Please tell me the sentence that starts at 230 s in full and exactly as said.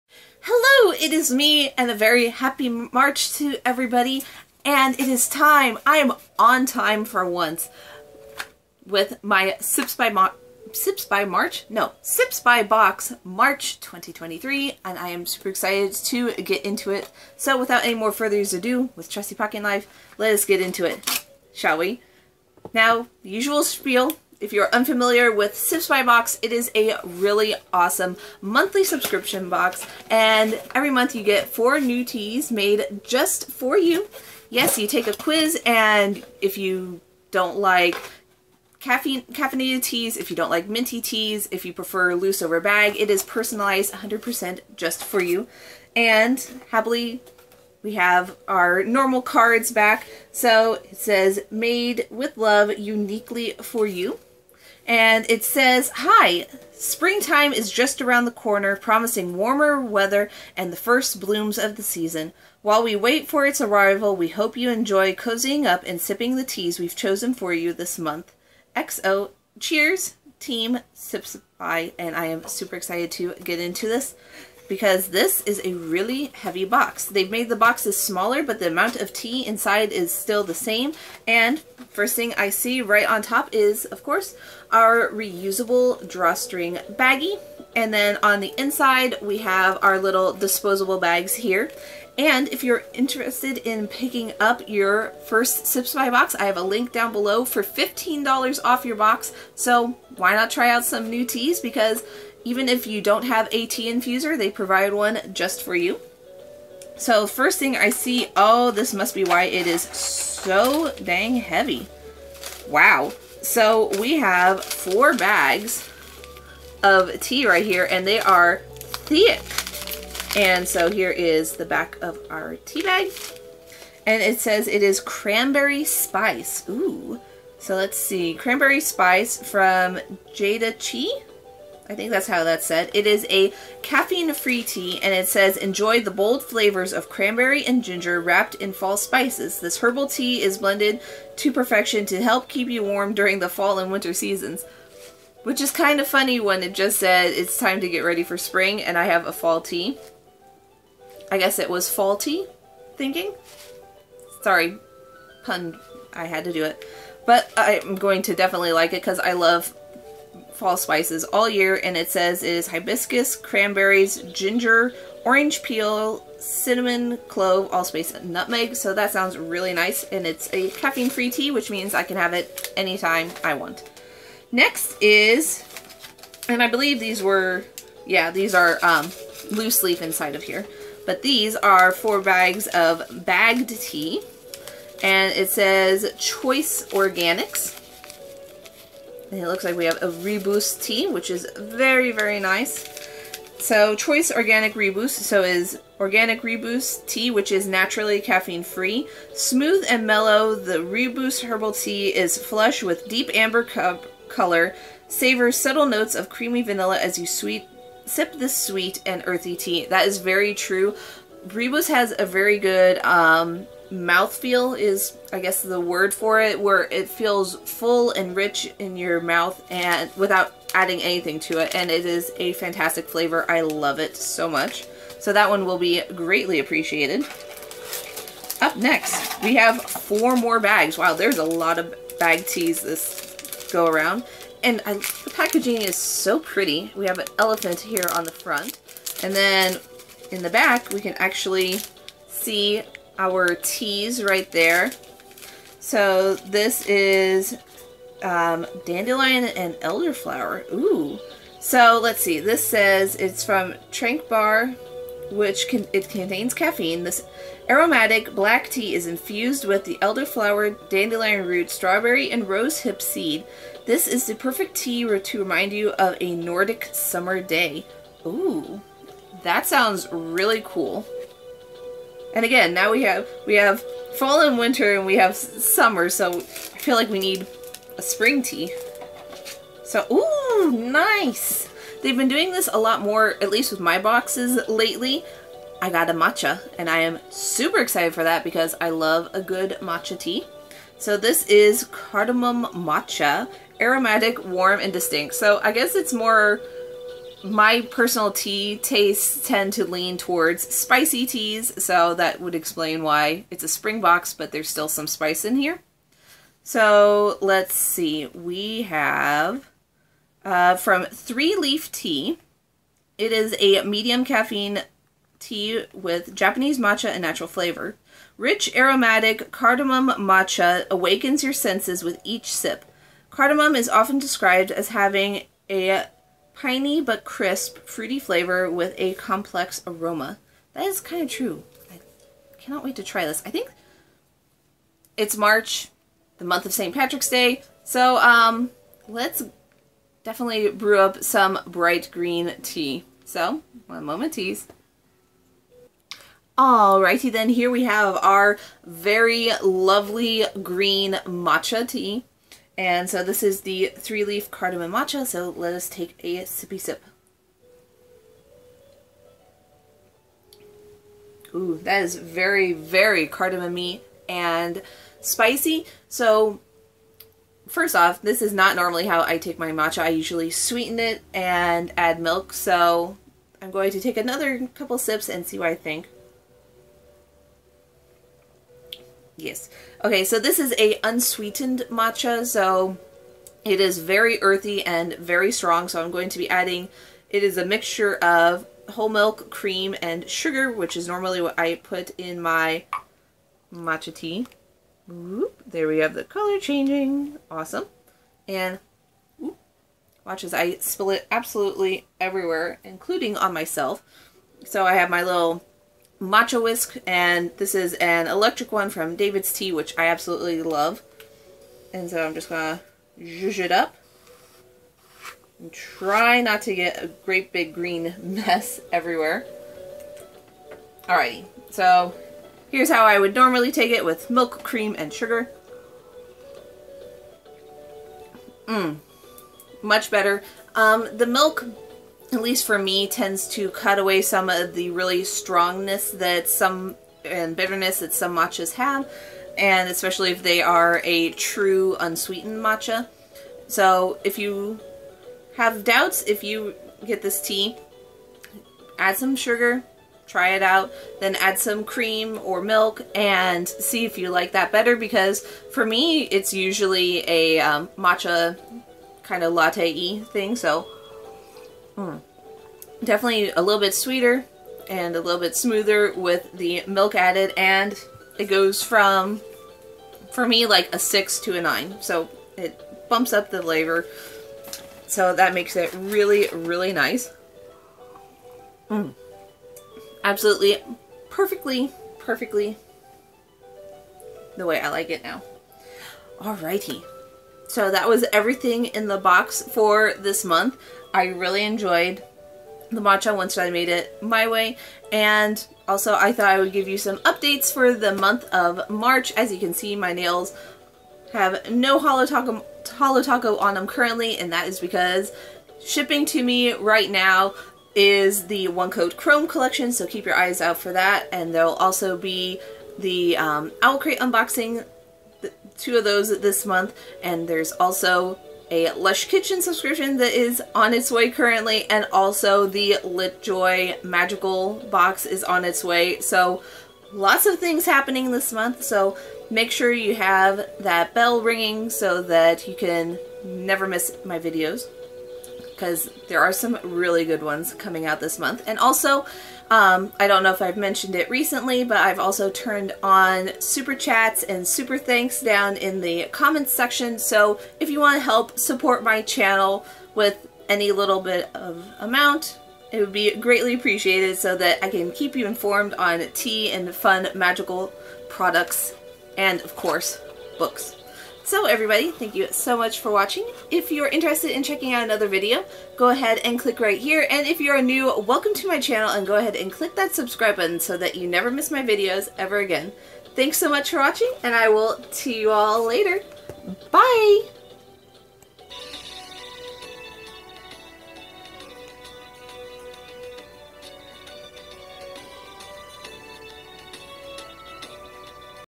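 Wow, there's a lot of bag teas this go around.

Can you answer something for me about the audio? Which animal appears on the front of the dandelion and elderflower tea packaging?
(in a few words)
Elephant.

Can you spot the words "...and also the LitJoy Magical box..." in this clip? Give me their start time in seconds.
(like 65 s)
521 s.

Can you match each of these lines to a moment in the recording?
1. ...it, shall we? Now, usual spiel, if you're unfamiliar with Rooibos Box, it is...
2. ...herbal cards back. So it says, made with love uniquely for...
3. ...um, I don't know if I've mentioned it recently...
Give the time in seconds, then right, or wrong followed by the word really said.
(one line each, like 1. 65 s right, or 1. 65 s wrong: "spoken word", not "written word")
1. 20 s wrong: "Sips", not "Rooibos"
2. 48 s wrong: "normal", not "herbal"
3. 539 s right.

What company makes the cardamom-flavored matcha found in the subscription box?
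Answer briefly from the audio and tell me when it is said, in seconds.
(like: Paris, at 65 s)
Three Leaf Tea, at 311 s.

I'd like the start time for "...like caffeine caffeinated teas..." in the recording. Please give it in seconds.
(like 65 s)
37 s.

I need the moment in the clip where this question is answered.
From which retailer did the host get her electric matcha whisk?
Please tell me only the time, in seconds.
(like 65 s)
409 s.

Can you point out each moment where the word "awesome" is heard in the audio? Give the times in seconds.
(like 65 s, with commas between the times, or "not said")
27 s, 397 s.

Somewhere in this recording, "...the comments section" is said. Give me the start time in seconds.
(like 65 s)
545 s.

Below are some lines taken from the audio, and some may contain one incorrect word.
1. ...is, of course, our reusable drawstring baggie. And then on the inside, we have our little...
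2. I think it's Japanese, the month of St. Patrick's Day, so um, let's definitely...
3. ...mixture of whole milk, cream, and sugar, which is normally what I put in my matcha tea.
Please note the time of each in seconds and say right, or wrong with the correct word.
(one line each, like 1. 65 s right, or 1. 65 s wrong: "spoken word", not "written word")
1. 83 s right
2. 333 s wrong: "March", not "Japanese"
3. 387 s right.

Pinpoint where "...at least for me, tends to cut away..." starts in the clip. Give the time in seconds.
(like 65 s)
432 s.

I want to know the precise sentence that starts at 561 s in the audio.
So everybody, thank you so much for watching.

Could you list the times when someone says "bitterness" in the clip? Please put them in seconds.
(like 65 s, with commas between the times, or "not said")
437 s.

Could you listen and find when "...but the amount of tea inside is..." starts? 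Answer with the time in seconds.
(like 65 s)
78 s.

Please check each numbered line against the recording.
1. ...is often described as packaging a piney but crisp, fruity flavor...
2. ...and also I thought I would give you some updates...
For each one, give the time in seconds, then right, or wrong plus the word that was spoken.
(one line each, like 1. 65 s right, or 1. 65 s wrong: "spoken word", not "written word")
1. 323 s wrong: "having", not "packaging"
2. 495 s right.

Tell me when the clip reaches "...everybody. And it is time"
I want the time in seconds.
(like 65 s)
3 s.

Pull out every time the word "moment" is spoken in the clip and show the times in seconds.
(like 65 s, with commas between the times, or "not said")
344 s.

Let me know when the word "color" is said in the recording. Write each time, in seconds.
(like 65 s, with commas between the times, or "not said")
204 s, 396 s.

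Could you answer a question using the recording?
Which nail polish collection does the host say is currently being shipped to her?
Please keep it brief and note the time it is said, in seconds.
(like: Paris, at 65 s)
One Coat Chrome, at 508 s.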